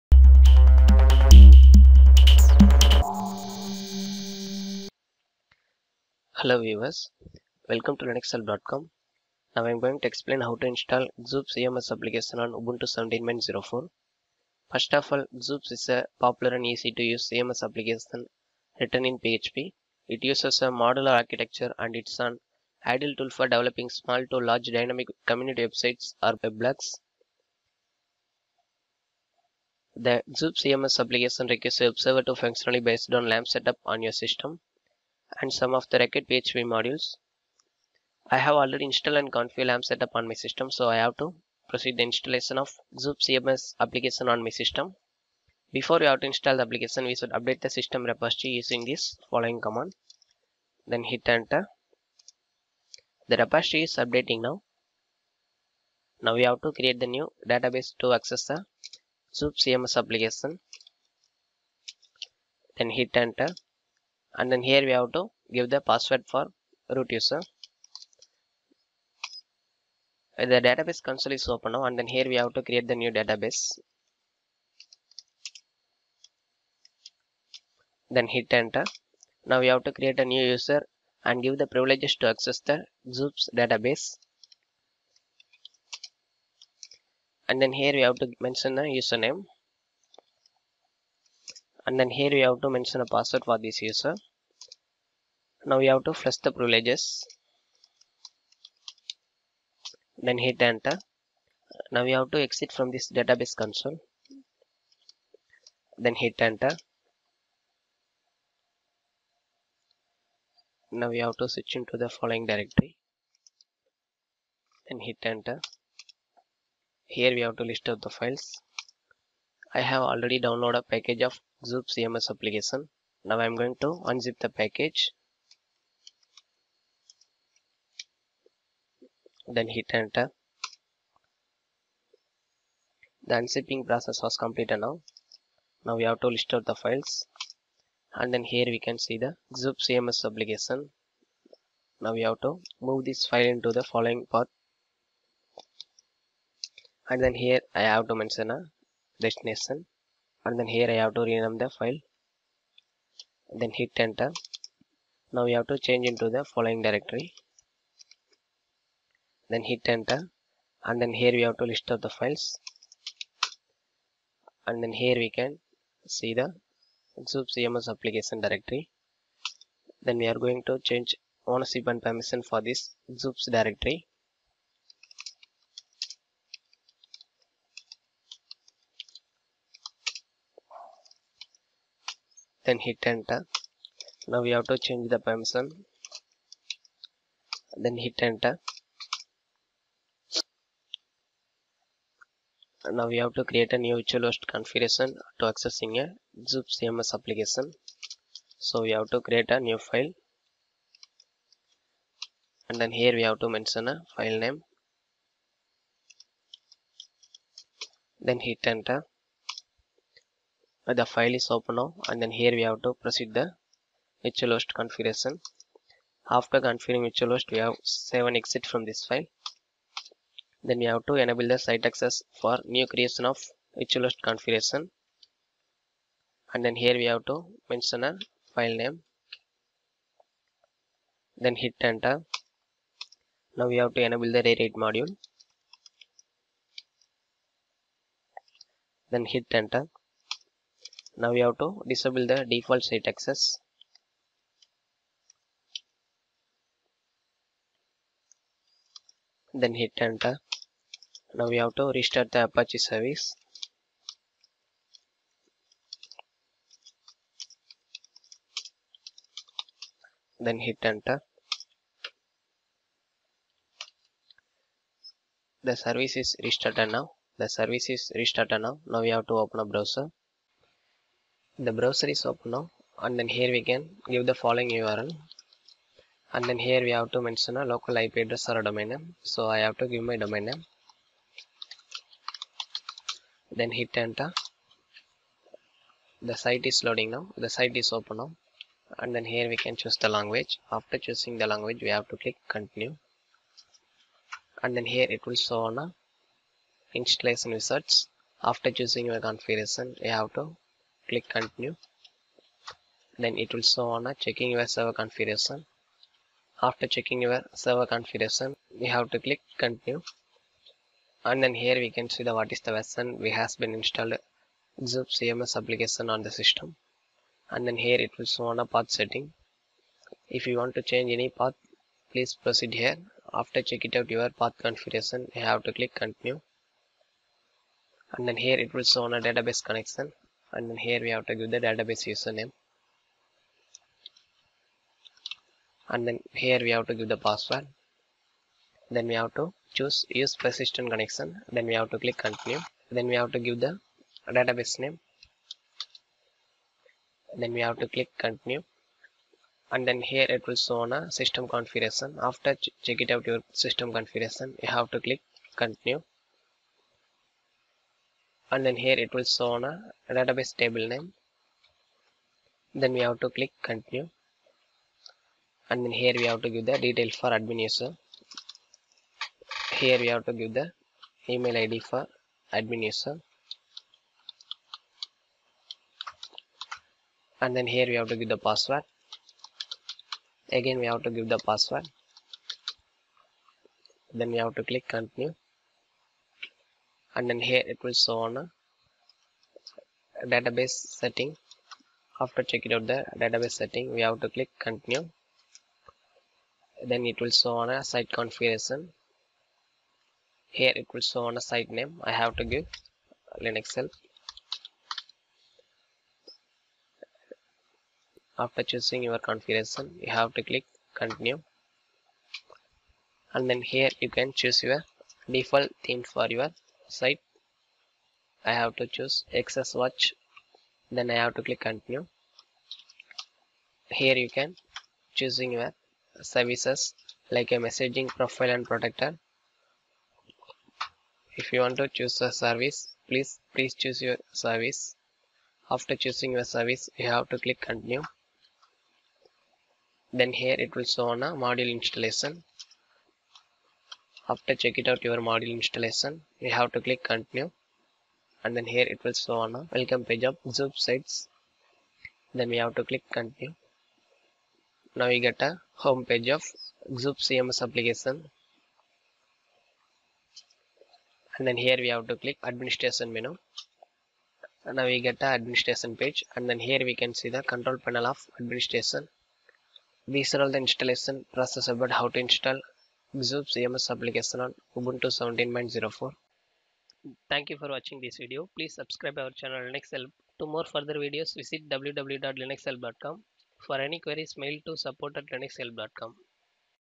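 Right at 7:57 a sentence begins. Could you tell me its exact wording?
Thank you for watching this video.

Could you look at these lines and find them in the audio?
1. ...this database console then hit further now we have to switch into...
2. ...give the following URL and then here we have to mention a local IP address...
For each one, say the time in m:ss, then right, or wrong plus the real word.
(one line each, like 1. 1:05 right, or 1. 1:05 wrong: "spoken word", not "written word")
1. 1:42 wrong: "enter", not "further"
2. 4:34 right.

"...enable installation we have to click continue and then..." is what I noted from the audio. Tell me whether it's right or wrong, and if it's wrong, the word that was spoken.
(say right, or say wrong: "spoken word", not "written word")
wrong: "module", not "enable".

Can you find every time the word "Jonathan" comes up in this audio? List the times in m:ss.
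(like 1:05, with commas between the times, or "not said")
not said.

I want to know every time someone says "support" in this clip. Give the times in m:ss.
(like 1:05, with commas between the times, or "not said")
8:04.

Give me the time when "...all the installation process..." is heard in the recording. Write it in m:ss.
7:50.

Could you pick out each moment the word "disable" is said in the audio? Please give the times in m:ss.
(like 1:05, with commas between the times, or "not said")
4:01.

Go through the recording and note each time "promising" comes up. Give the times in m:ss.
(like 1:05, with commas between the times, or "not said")
not said.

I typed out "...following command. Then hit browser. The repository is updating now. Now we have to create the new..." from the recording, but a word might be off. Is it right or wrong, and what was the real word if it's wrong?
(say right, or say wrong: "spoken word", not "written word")
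wrong: "enter", not "browser".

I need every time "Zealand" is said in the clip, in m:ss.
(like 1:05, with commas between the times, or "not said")
not said.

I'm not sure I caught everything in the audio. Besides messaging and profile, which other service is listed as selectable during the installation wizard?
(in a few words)
protector.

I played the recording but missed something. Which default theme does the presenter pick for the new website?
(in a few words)
XS watch.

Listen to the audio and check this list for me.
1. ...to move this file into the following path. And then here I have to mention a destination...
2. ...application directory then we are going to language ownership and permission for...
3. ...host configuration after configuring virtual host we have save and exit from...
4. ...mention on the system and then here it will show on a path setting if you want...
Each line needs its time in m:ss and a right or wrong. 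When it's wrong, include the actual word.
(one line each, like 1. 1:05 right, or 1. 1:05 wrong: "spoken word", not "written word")
1. 2:22 right
2. 2:47 wrong: "change", not "language"
3. 3:34 right
4. 5:15 wrong: "application", not "mention".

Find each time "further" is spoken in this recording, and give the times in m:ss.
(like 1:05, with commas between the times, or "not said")
8:00.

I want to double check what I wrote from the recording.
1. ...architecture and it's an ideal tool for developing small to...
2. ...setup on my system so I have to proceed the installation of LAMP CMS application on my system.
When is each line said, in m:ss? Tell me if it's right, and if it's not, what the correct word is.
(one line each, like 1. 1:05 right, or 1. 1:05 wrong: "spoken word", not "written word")
1. 0:21 right
2. 0:39 wrong: "Xoops", not "LAMP".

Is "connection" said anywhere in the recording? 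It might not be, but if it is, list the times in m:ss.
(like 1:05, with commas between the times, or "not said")
5:29, 5:40.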